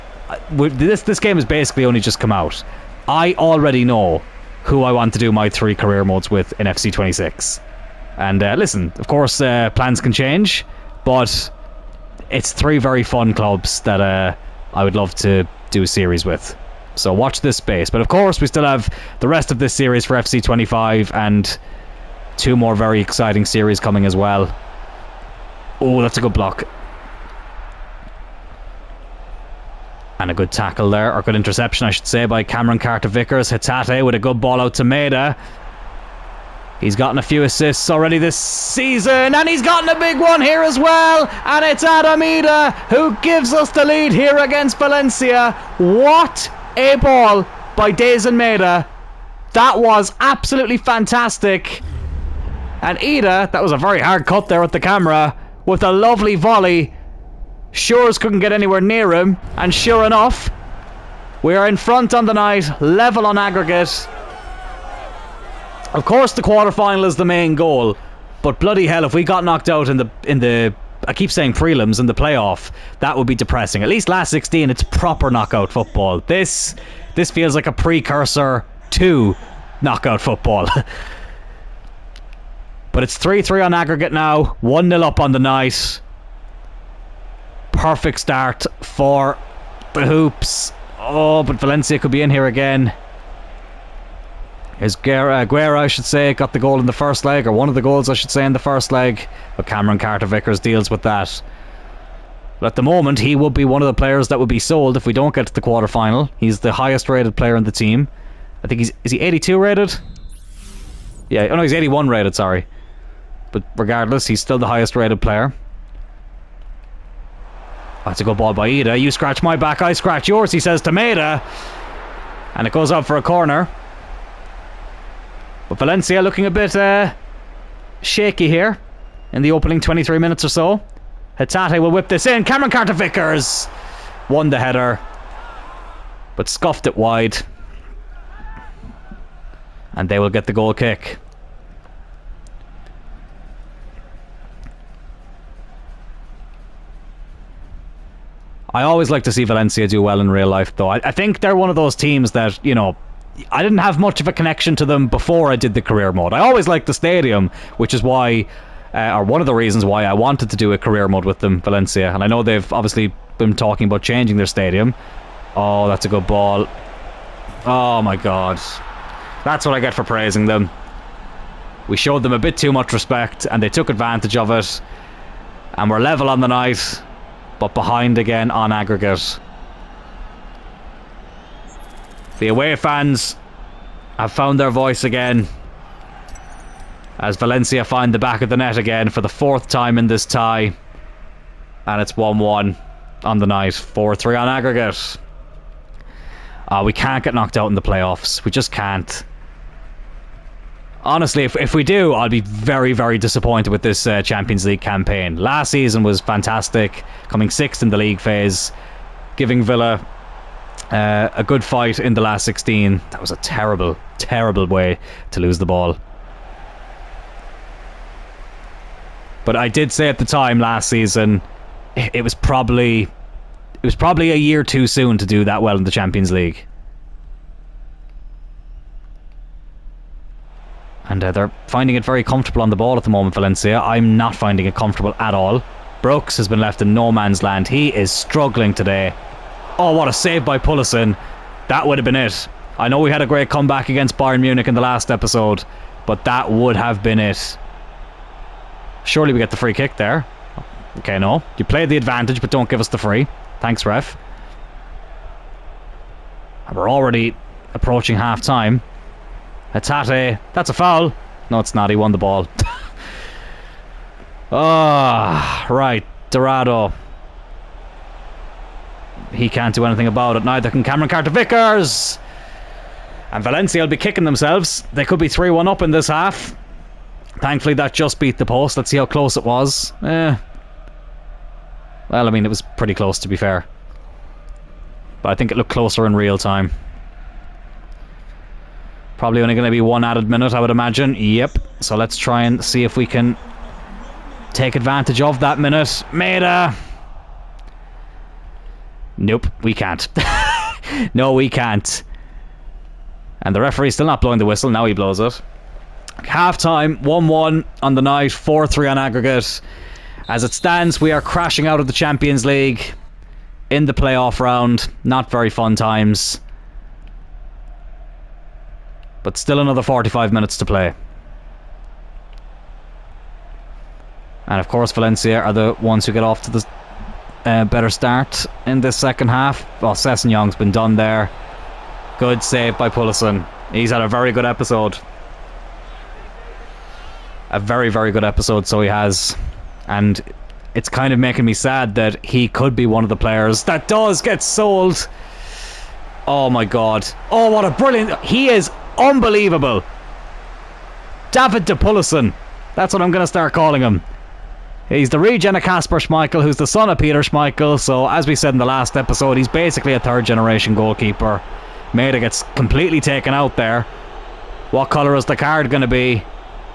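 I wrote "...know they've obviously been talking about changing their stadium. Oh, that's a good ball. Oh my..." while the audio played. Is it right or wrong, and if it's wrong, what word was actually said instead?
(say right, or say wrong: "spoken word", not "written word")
right.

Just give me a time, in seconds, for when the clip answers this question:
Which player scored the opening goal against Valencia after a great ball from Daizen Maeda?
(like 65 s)
41 s.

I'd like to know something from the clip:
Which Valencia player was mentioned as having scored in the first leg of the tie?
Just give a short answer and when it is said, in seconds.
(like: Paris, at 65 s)
Guerra, at 95 s.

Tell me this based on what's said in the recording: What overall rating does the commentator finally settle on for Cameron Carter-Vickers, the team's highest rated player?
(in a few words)
81.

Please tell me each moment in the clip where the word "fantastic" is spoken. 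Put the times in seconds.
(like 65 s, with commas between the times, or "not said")
50 s, 206 s.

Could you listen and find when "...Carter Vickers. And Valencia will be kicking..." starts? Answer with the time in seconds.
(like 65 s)
271 s.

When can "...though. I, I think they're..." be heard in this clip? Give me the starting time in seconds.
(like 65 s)
150 s.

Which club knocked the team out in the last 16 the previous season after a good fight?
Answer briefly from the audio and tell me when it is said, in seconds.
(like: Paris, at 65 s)
Villa, at 209 s.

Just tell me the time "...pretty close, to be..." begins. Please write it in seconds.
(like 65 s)
282 s.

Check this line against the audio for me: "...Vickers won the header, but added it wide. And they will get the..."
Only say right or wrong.
wrong.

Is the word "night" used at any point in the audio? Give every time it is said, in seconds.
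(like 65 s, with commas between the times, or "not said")
62 s, 85 s, 176 s, 193 s, 308 s.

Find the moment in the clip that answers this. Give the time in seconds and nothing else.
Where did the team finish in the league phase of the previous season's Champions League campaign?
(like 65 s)
207 s.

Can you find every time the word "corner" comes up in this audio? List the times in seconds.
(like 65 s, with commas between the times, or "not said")
123 s.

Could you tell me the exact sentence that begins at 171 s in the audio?
We showed them a bit too much respect and they took advantage of it.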